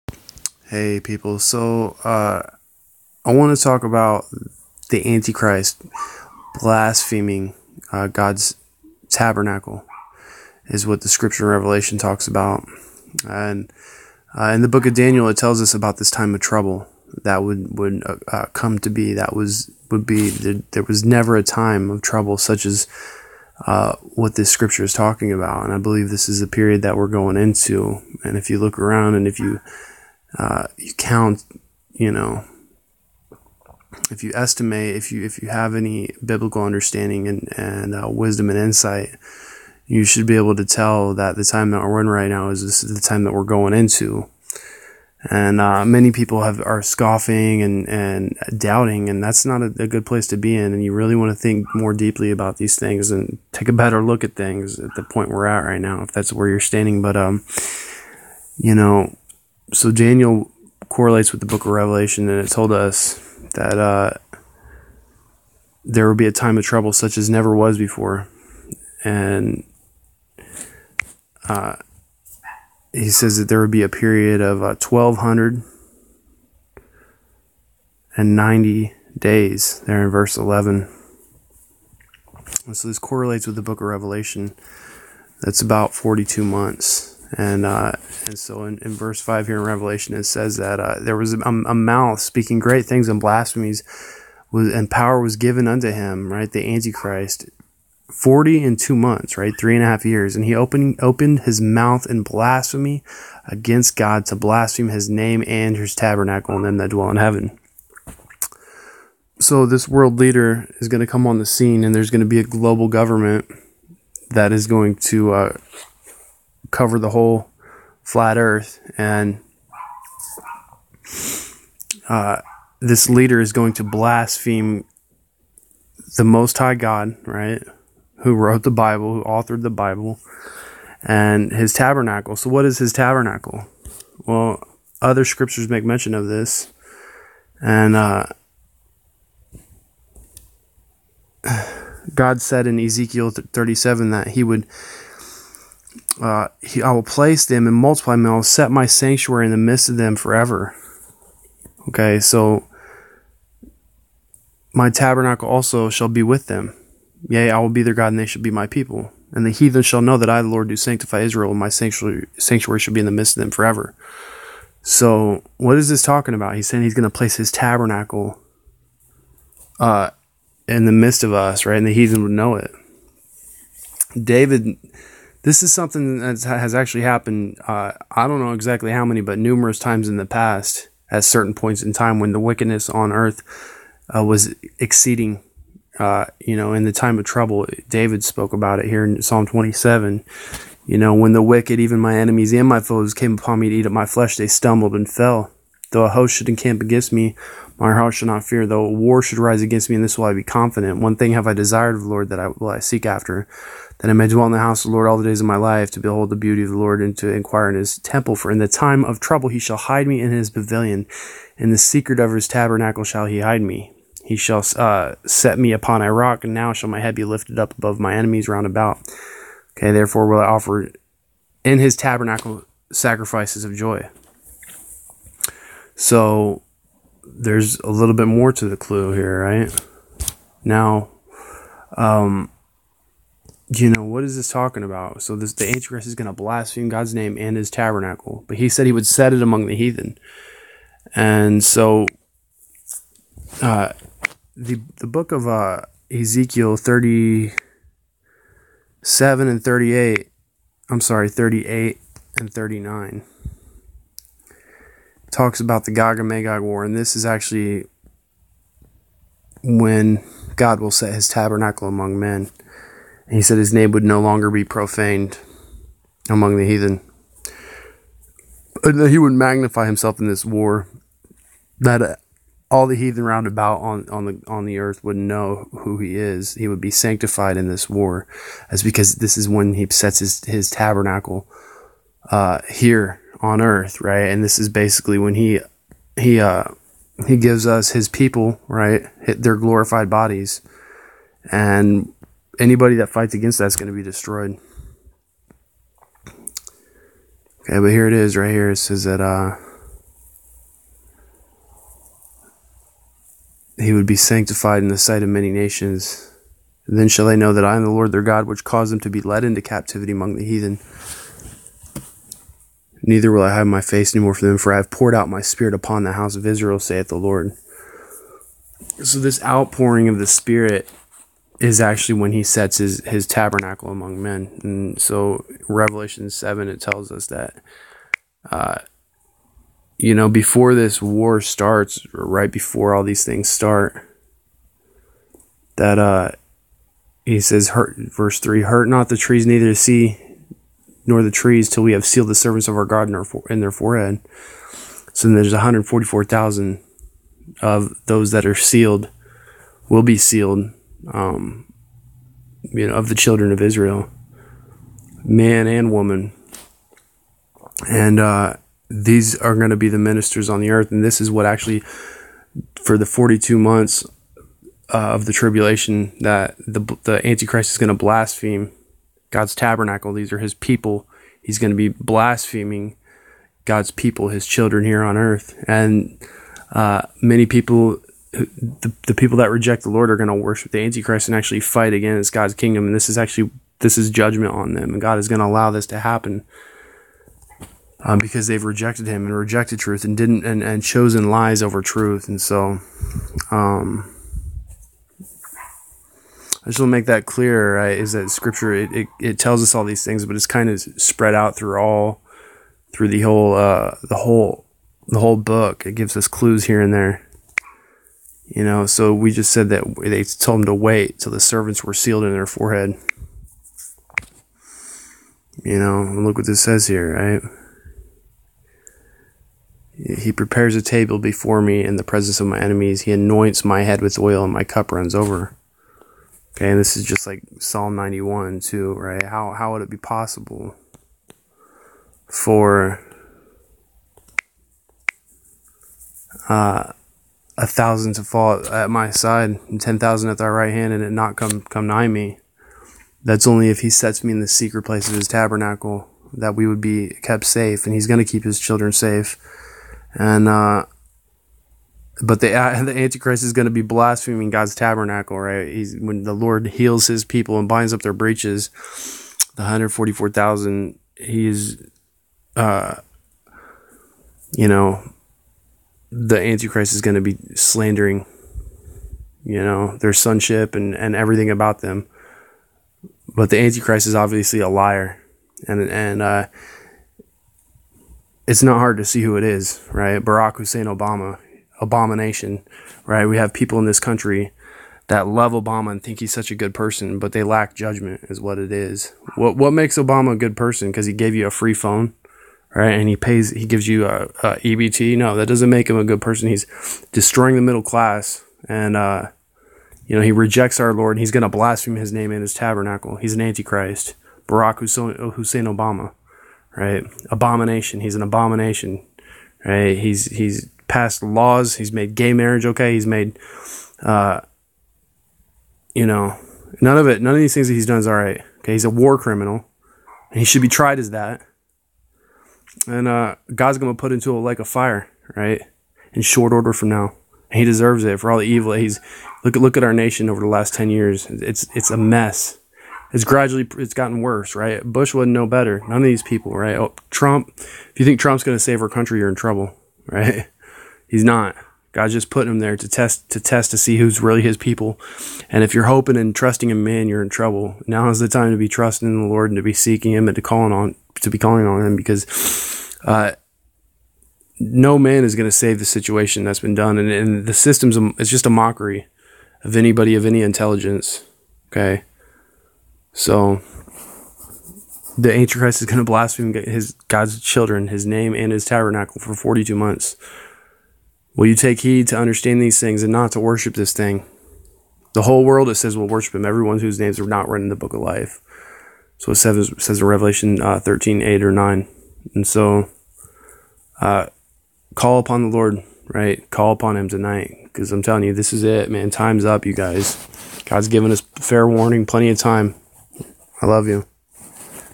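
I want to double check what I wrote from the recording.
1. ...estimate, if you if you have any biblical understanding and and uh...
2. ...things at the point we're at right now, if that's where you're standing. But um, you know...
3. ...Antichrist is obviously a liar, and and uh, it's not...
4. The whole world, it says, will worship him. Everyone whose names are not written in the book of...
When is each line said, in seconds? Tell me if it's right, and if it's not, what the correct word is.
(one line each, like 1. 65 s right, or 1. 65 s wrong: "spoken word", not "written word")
1. 34 s right
2. 54 s right
3. 473 s right
4. 575 s right.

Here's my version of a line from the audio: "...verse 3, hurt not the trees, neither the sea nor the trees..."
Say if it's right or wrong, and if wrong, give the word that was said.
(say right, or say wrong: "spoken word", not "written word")
right.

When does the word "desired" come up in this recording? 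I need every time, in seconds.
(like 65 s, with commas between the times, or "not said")
201 s.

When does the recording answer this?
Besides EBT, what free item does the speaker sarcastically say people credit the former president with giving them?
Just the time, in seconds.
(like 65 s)
491 s.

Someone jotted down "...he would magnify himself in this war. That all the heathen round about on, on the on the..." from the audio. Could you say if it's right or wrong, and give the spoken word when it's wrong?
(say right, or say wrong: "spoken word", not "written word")
right.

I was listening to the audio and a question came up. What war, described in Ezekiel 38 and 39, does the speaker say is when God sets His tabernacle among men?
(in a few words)
Gog and Magog war.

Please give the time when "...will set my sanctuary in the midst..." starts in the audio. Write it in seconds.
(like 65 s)
148 s.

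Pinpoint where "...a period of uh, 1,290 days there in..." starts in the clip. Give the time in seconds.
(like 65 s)
73 s.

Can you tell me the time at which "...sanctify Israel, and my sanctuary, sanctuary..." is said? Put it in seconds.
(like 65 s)
160 s.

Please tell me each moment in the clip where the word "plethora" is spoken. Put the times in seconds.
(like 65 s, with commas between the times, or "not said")
not said.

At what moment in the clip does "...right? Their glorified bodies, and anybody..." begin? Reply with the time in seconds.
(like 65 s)
288 s.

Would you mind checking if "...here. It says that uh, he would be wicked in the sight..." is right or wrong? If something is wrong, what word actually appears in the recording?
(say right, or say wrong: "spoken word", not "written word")
wrong: "sanctified", not "wicked".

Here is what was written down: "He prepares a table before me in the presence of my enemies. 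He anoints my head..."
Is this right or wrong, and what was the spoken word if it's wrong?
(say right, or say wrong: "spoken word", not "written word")
right.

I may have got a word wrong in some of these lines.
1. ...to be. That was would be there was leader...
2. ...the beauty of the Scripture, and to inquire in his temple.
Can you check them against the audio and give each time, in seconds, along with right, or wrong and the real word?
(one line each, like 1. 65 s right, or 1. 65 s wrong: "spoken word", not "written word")
1. 18 s wrong: "never", not "leader"
2. 206 s wrong: "Lord", not "Scripture".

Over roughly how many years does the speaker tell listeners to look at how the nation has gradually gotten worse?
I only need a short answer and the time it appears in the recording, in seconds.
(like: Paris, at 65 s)
10 years, at 530 s.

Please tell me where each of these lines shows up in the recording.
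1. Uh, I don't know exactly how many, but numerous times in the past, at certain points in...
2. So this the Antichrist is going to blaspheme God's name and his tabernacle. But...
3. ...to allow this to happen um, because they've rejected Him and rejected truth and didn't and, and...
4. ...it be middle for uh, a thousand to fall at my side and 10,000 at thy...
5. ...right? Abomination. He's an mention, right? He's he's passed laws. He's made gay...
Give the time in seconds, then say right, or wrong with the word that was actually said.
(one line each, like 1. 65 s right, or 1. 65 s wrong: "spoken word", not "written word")
1. 177 s right
2. 235 s right
3. 385 s right
4. 429 s wrong: "possible", not "middle"
5. 506 s wrong: "abomination", not "mention".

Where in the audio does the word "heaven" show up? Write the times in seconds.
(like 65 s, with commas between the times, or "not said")
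107 s.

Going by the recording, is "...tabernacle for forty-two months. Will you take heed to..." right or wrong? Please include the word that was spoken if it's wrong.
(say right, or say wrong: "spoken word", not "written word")
right.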